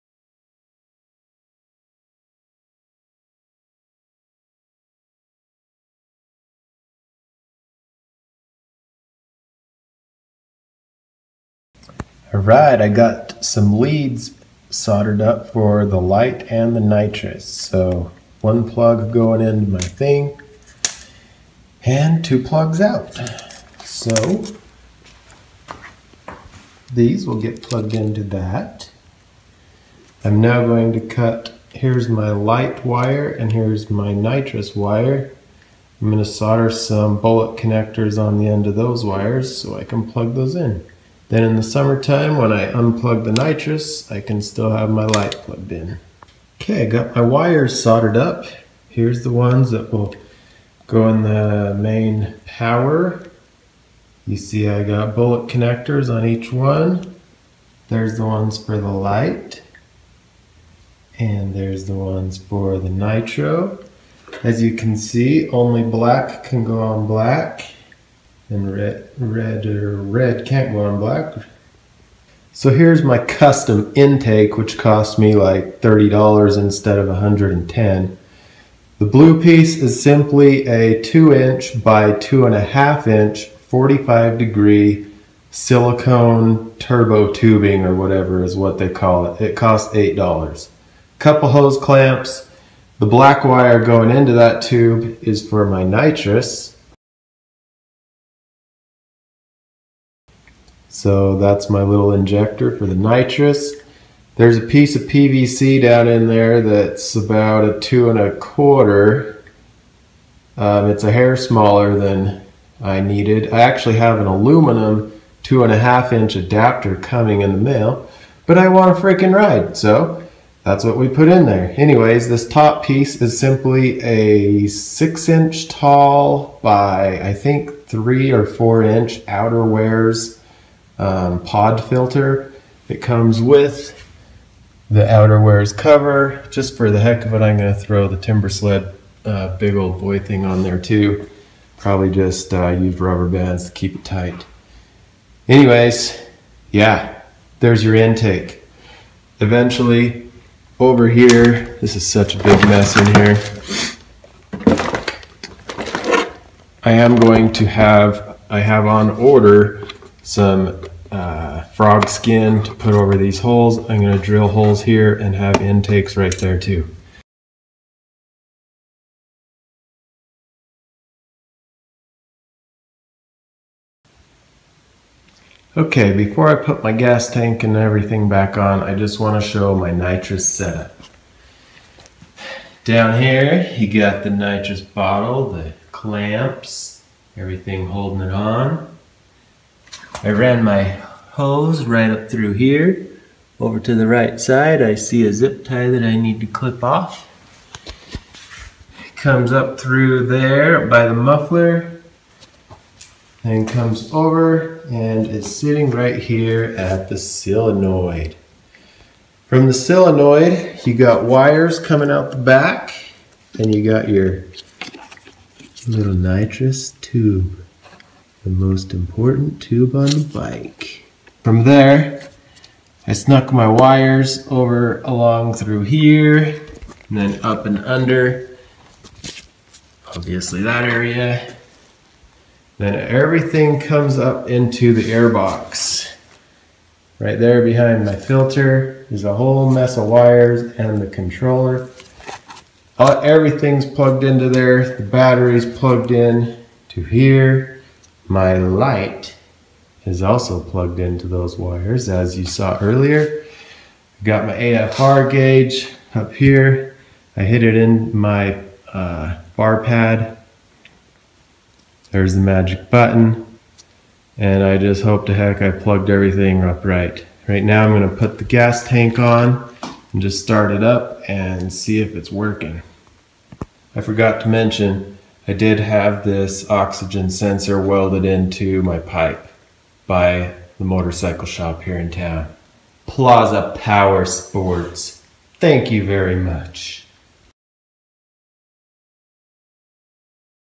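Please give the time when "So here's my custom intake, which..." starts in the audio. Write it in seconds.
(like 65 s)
72 s.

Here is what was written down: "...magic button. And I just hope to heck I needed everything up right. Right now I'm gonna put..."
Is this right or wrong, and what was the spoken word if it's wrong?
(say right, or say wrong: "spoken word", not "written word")
wrong: "plugged", not "needed".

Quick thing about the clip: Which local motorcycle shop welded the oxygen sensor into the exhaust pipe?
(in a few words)
Plaza Power Sports.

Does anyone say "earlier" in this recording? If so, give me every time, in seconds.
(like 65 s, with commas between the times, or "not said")
252 s.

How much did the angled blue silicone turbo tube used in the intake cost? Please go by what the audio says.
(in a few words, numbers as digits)
$8.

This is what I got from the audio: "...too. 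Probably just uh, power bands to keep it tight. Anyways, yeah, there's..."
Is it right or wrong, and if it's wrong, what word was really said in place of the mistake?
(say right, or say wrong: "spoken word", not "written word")
wrong: "rubber", not "power".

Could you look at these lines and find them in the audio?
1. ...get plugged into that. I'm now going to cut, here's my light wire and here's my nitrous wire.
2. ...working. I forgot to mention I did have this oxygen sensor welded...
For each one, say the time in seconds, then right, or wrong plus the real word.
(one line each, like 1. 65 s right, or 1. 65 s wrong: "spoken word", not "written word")
1. 27 s right
2. 272 s right.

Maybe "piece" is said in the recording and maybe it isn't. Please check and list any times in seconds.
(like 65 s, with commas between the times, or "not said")
79 s, 104 s, 122 s.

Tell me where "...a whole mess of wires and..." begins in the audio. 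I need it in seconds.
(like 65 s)
239 s.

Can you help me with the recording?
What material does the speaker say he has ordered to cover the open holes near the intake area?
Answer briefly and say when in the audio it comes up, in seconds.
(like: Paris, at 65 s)
frog skin, at 161 s.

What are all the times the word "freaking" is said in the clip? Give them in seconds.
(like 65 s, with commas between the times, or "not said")
119 s.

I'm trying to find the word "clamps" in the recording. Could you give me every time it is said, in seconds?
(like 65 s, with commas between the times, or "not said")
91 s, 185 s.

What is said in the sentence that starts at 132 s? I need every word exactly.
It comes with the outerwear's cover.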